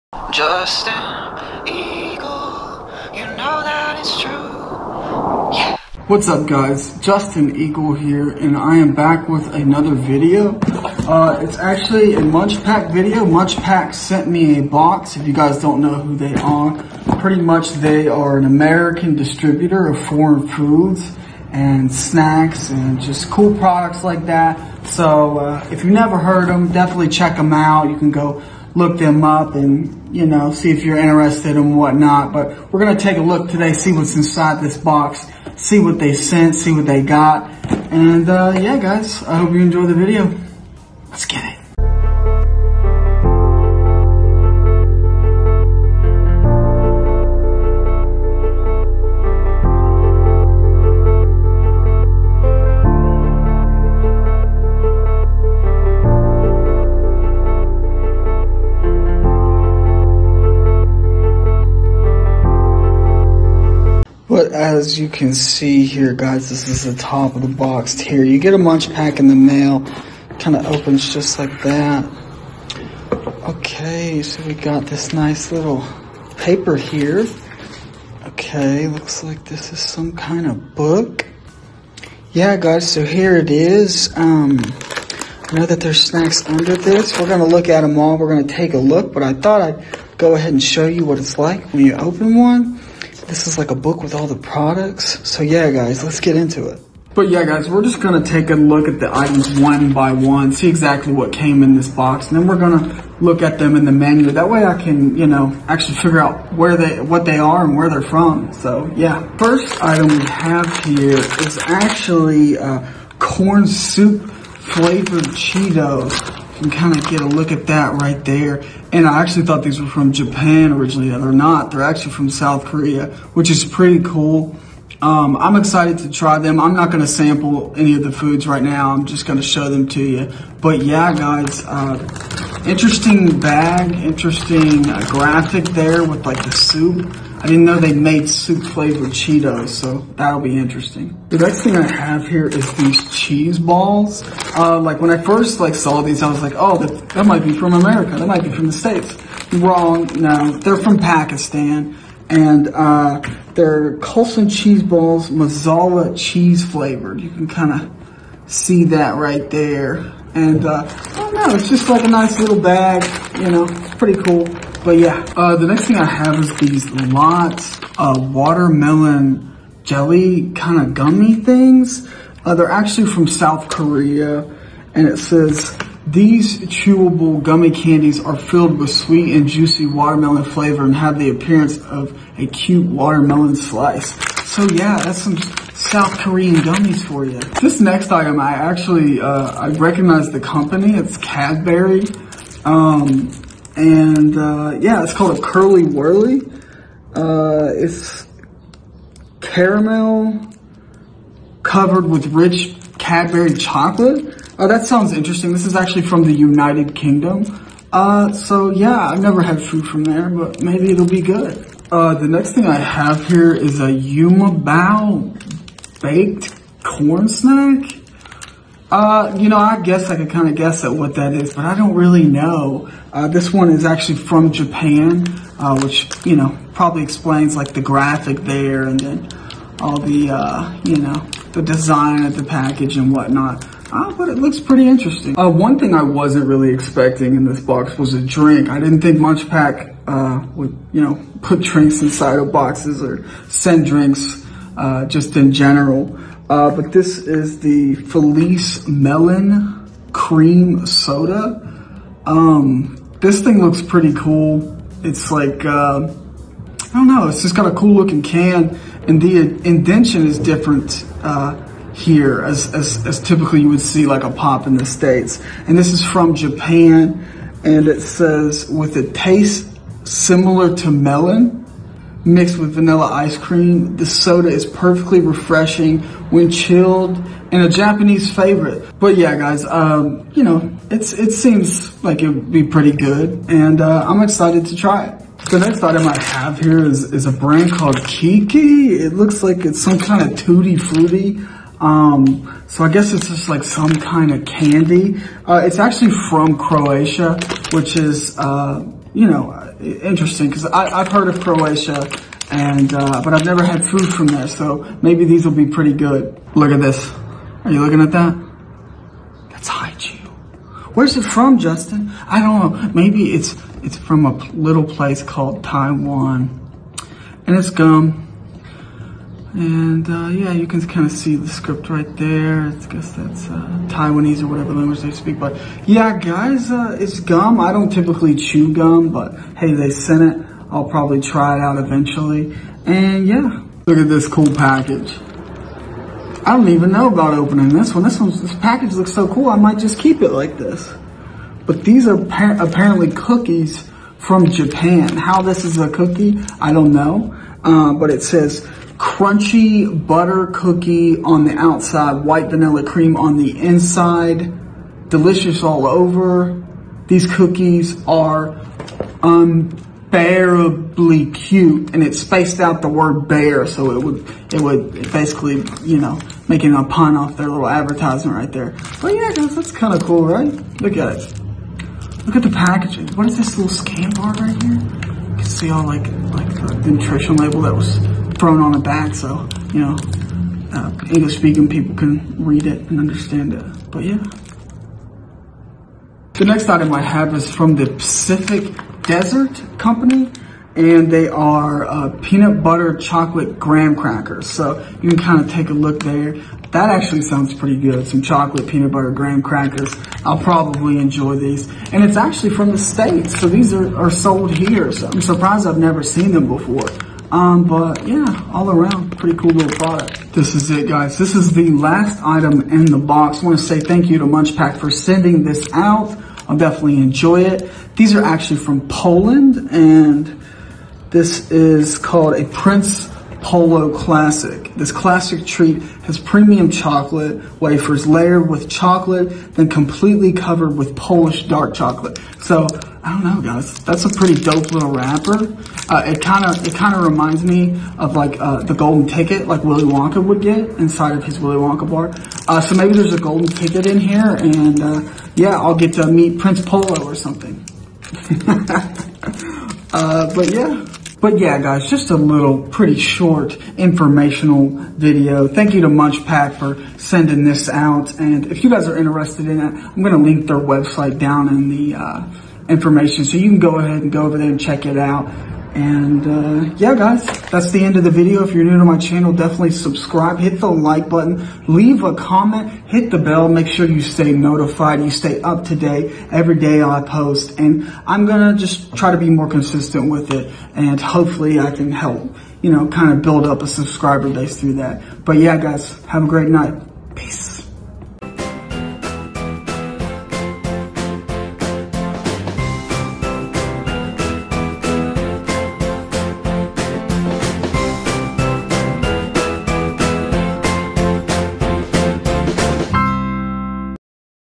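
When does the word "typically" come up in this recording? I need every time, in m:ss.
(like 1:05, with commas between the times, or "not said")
4:23, 5:27.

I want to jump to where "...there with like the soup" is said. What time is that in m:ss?
2:15.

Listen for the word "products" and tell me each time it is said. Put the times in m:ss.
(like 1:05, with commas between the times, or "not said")
0:23, 1:34, 6:49.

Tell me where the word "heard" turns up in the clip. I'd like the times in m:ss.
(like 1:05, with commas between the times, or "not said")
0:26, 5:01.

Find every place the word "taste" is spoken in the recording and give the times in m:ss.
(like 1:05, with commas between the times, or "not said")
4:29.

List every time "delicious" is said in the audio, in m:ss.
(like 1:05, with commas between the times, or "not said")
5:55.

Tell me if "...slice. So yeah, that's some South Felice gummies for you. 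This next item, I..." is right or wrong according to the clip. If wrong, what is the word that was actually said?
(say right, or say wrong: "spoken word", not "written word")
wrong: "Korean", not "Felice".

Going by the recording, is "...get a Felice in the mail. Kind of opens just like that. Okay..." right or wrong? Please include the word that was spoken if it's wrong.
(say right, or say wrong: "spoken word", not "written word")
wrong: "MunchPak", not "Felice".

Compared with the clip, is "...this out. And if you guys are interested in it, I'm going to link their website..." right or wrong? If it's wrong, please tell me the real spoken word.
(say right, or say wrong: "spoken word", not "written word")
right.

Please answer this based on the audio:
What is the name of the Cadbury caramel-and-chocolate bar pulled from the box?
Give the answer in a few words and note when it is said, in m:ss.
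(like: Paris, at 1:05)
Curly Wurly, at 3:15.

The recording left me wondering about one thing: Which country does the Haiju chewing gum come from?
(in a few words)
Taiwan.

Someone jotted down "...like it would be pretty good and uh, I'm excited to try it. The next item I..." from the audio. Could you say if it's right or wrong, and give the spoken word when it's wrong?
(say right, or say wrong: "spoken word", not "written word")
right.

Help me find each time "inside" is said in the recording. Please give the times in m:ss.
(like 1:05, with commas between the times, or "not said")
0:34, 4:02, 5:53, 7:20.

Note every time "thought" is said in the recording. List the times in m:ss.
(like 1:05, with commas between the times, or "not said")
1:29, 1:59.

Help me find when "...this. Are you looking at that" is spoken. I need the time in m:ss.
5:06.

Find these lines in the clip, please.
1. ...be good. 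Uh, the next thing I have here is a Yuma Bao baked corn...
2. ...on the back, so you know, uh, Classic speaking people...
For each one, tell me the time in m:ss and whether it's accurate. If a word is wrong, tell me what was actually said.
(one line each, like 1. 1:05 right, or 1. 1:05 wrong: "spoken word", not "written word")
1. 3:31 right
2. 6:18 wrong: "English", not "Classic".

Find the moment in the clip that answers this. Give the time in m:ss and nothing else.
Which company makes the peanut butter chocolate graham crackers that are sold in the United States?
6:27.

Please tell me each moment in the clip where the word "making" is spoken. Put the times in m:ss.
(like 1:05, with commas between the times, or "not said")
6:06.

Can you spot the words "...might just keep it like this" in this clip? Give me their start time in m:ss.
5:39.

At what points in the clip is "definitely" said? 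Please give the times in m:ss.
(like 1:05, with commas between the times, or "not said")
0:26, 6:56, 7:49.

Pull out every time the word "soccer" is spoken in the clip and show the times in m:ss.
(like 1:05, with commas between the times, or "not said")
not said.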